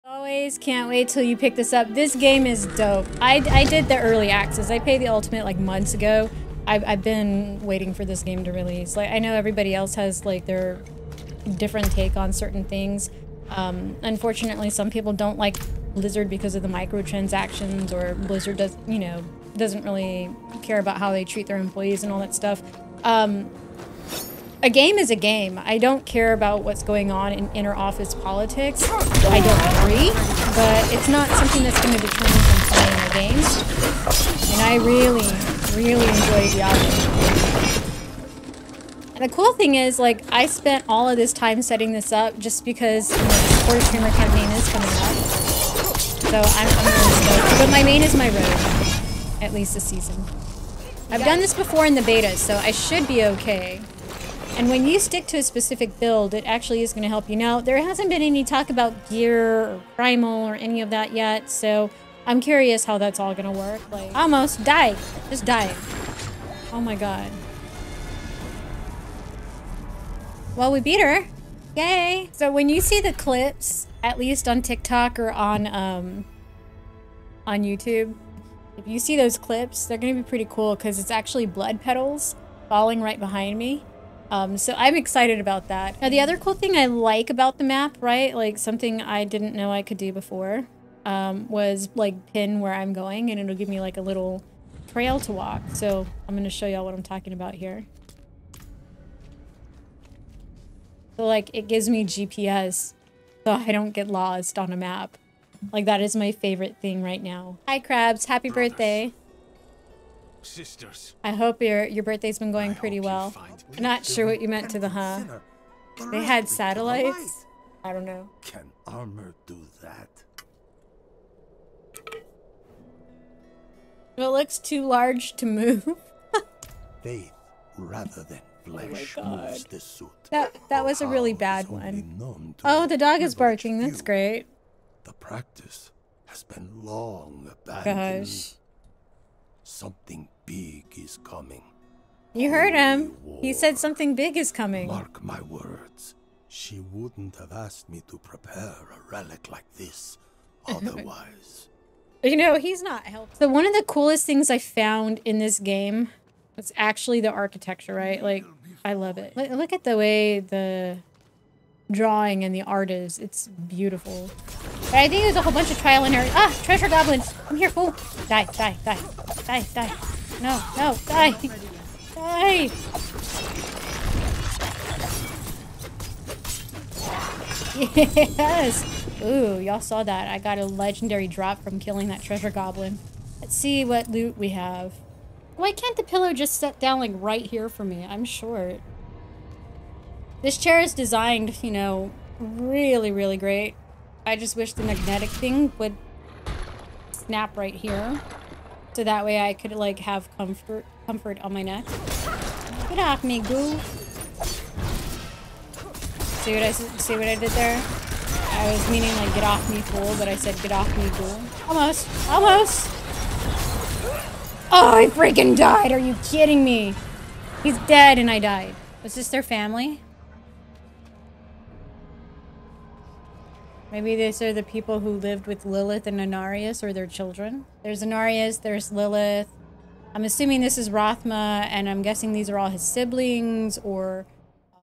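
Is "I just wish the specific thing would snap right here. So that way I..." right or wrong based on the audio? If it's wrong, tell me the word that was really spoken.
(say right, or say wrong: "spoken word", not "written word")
wrong: "magnetic", not "specific".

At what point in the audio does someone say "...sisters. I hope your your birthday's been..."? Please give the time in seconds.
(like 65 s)
110 s.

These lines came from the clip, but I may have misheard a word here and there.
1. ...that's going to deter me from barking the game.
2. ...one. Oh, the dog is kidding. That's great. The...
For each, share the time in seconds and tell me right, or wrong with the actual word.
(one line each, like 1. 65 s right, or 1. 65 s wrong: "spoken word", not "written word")
1. 31 s wrong: "playing", not "barking"
2. 131 s wrong: "barking", not "kidding".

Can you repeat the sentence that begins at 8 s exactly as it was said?
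Like I know everybody else has like their different take on certain things.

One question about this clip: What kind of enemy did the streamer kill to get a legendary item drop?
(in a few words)
Treasure goblin.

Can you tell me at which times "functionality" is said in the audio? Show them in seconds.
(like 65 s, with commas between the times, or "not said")
not said.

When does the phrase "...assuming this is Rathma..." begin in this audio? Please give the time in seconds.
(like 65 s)
230 s.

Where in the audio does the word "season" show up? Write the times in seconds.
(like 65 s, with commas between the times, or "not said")
49 s.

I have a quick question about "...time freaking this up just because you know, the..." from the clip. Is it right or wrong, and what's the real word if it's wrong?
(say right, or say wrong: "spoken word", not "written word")
wrong: "setting", not "freaking".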